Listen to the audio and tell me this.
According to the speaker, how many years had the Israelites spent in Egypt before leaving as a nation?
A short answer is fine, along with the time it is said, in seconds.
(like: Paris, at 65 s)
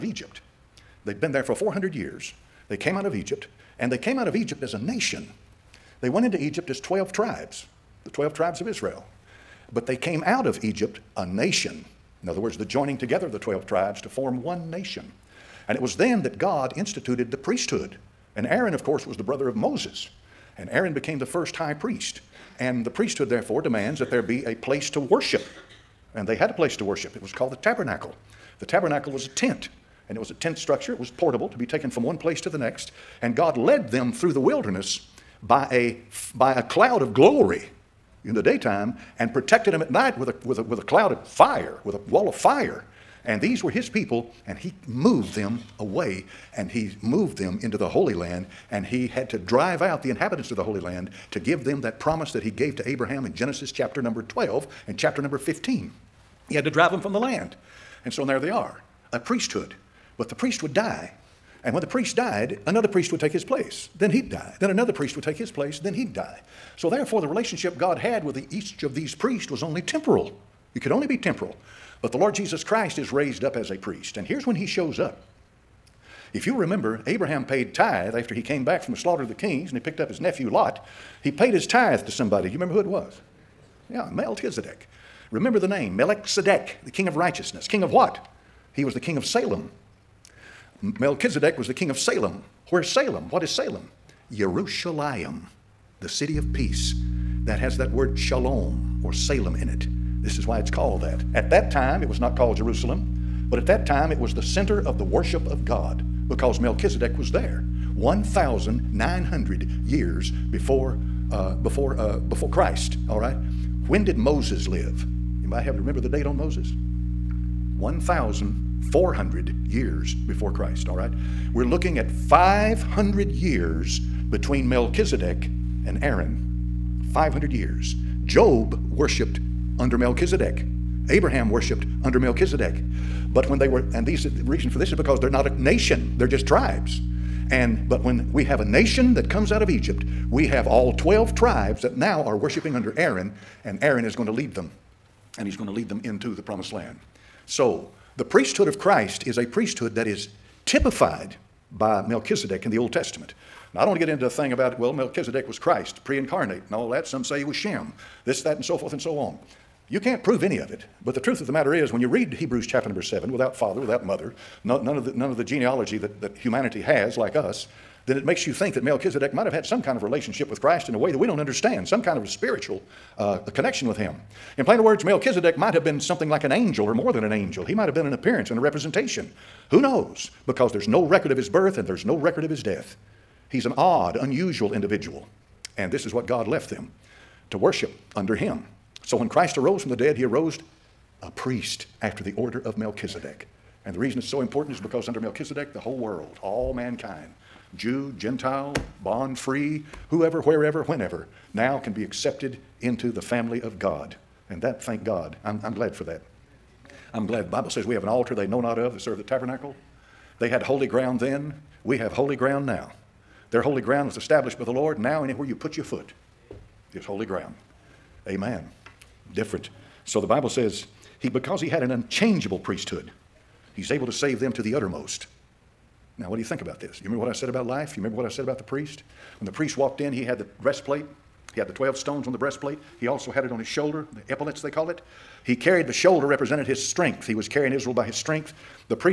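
400 years, at 1 s.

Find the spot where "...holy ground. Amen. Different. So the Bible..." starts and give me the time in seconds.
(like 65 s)
217 s.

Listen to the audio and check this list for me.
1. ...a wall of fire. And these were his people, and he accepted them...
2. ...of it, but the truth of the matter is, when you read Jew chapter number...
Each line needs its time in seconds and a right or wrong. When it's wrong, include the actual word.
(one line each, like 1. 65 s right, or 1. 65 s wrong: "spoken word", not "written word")
1. 41 s wrong: "moved", not "accepted"
2. 160 s wrong: "Hebrews", not "Jew".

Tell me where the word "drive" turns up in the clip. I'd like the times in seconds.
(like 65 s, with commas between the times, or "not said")
49 s, 56 s.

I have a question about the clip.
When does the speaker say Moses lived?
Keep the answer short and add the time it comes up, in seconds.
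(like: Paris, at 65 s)
1,400 years before Christ, at 117 s.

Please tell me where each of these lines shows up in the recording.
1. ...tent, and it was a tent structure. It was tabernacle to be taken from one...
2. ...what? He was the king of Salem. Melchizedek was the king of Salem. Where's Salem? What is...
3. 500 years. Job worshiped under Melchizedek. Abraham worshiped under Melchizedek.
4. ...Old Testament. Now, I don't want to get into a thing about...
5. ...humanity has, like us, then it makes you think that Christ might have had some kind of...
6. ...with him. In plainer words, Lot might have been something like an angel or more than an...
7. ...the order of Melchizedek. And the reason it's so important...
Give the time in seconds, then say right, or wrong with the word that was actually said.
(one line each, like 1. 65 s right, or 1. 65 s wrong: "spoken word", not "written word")
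1. 29 s wrong: "portable", not "tabernacle"
2. 87 s right
3. 127 s right
4. 152 s right
5. 166 s wrong: "Melchizedek", not "Christ"
6. 173 s wrong: "Melchizedek", not "Lot"
7. 192 s right.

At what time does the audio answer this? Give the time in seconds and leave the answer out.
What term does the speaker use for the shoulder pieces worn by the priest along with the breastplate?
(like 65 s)
234 s.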